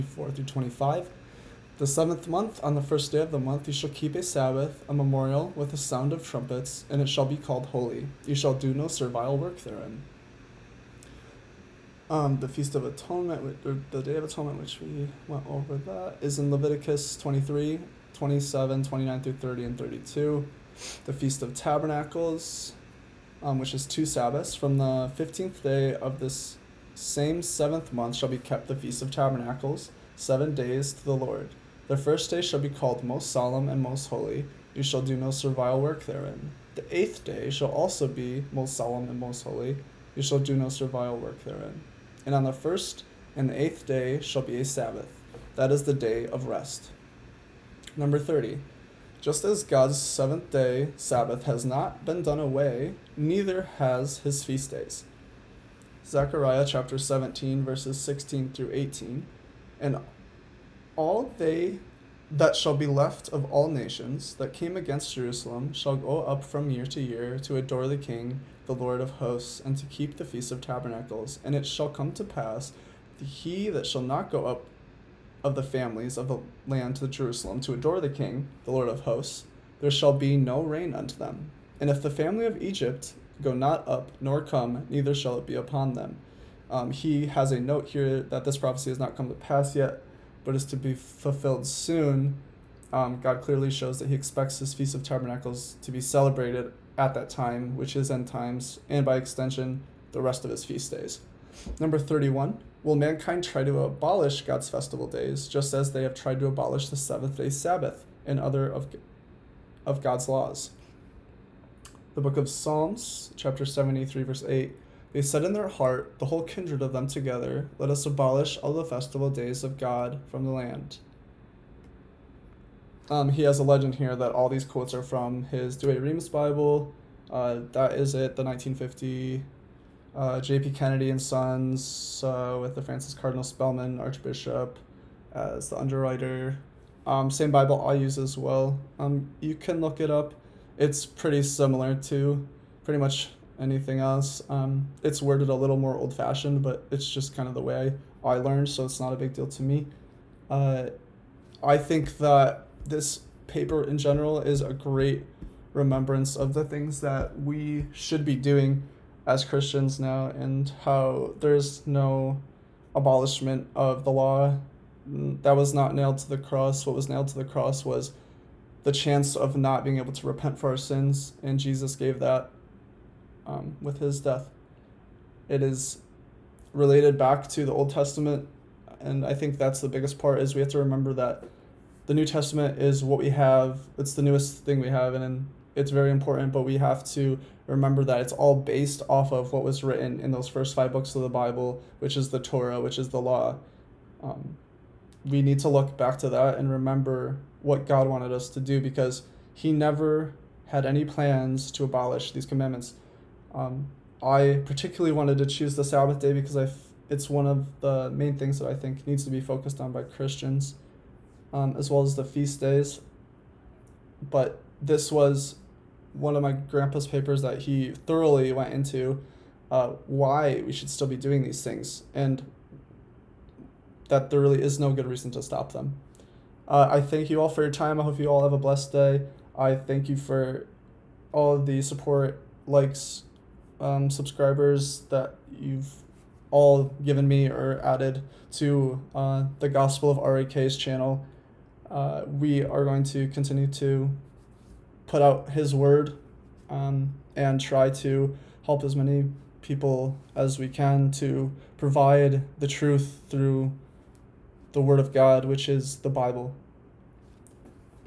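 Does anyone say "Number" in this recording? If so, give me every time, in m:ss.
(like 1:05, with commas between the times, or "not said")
0:47, 1:41.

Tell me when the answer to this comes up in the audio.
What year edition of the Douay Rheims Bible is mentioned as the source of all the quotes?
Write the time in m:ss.
2:08.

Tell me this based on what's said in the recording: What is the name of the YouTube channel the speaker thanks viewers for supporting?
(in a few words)
Gospel of RAK.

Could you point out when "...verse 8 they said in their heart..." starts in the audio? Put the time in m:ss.
1:54.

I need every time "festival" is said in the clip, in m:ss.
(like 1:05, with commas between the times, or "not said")
1:44, 1:58.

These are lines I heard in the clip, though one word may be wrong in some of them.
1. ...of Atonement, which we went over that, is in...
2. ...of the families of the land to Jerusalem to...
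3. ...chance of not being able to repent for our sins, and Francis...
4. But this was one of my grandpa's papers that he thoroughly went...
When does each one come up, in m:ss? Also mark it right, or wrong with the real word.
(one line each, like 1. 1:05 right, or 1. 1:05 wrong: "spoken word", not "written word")
1. 0:14 right
2. 1:15 right
3. 2:48 wrong: "Jesus", not "Francis"
4. 3:34 right.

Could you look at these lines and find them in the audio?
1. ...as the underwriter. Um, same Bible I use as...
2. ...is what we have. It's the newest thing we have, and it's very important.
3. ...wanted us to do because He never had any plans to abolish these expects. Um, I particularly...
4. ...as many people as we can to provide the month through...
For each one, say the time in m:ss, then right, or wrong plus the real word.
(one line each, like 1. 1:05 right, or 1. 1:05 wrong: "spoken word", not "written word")
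1. 2:15 right
2. 3:02 right
3. 3:18 wrong: "commandments", not "expects"
4. 4:08 wrong: "truth", not "month".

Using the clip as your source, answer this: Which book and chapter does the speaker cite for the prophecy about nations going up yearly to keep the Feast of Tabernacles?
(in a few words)
Zechariah 17.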